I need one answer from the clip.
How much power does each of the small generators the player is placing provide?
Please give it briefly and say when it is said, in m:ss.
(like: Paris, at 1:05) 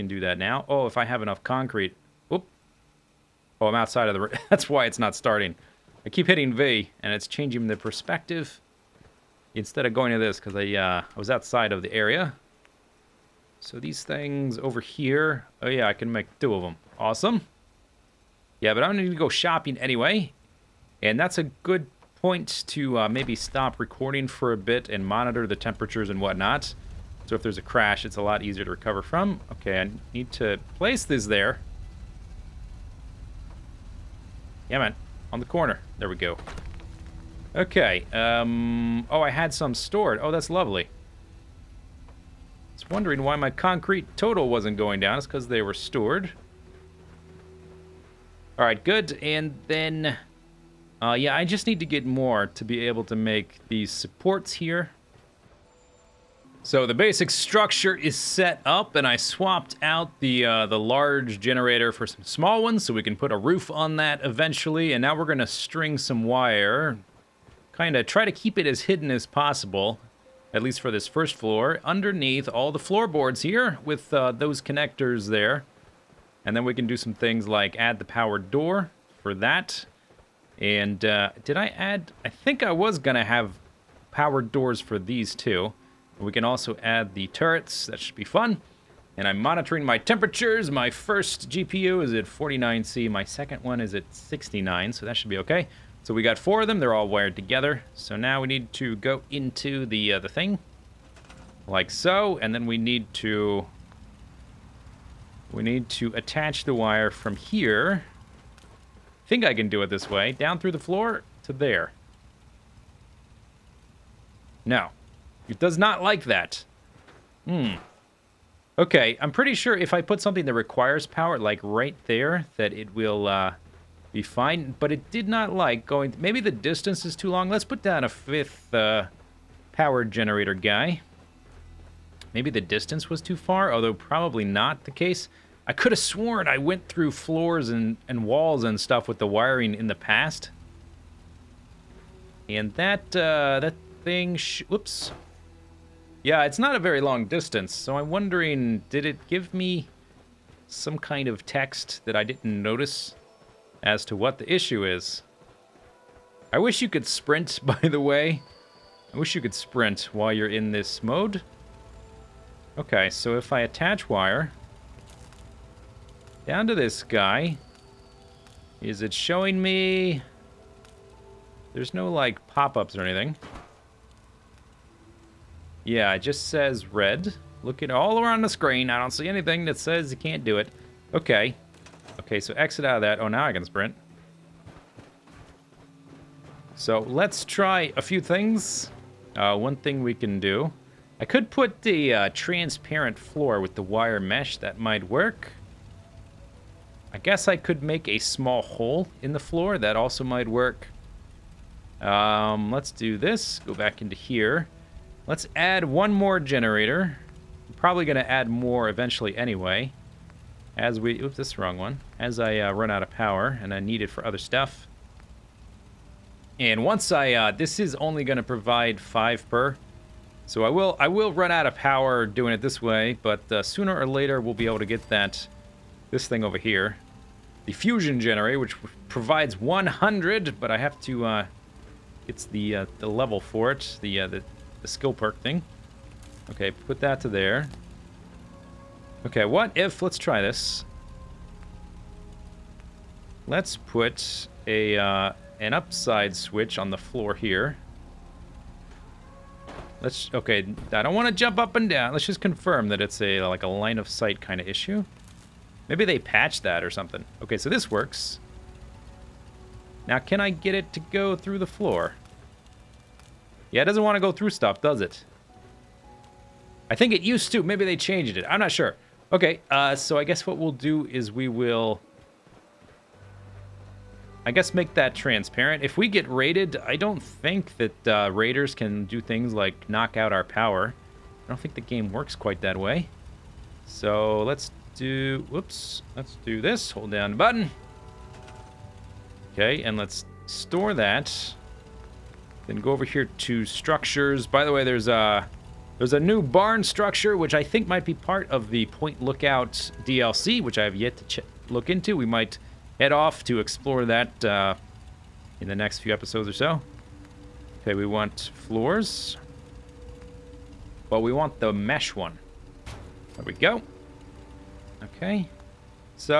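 5, at 3:38.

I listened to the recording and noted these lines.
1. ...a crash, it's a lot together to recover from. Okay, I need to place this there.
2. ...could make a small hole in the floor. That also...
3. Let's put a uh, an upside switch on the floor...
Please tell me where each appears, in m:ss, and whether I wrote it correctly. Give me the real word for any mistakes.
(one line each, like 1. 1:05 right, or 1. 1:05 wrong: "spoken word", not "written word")
1. 0:27 wrong: "easier", not "together"
2. 3:17 right
3. 4:03 right.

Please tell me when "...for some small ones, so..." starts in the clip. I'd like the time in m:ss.
1:01.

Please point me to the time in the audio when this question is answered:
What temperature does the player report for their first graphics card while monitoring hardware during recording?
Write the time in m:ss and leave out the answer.
1:32.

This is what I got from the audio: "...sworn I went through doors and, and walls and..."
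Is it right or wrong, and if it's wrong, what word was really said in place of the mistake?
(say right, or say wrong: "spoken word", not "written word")
wrong: "floors", not "doors".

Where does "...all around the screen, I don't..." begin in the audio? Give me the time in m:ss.
2:57.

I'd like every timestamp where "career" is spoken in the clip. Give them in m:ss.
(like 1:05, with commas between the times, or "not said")
not said.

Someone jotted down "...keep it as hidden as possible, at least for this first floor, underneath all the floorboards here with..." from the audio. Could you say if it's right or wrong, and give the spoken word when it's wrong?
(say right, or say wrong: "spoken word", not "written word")
right.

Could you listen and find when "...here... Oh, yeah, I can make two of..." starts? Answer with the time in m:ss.
0:14.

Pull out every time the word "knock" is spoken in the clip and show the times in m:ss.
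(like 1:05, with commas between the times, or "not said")
4:39.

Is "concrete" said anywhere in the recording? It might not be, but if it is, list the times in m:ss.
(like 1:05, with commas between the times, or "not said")
0:01, 0:43.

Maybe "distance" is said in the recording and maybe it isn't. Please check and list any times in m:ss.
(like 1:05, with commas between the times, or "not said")
2:06, 2:12, 2:27.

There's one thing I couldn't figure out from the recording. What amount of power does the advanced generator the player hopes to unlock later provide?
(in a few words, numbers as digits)
100.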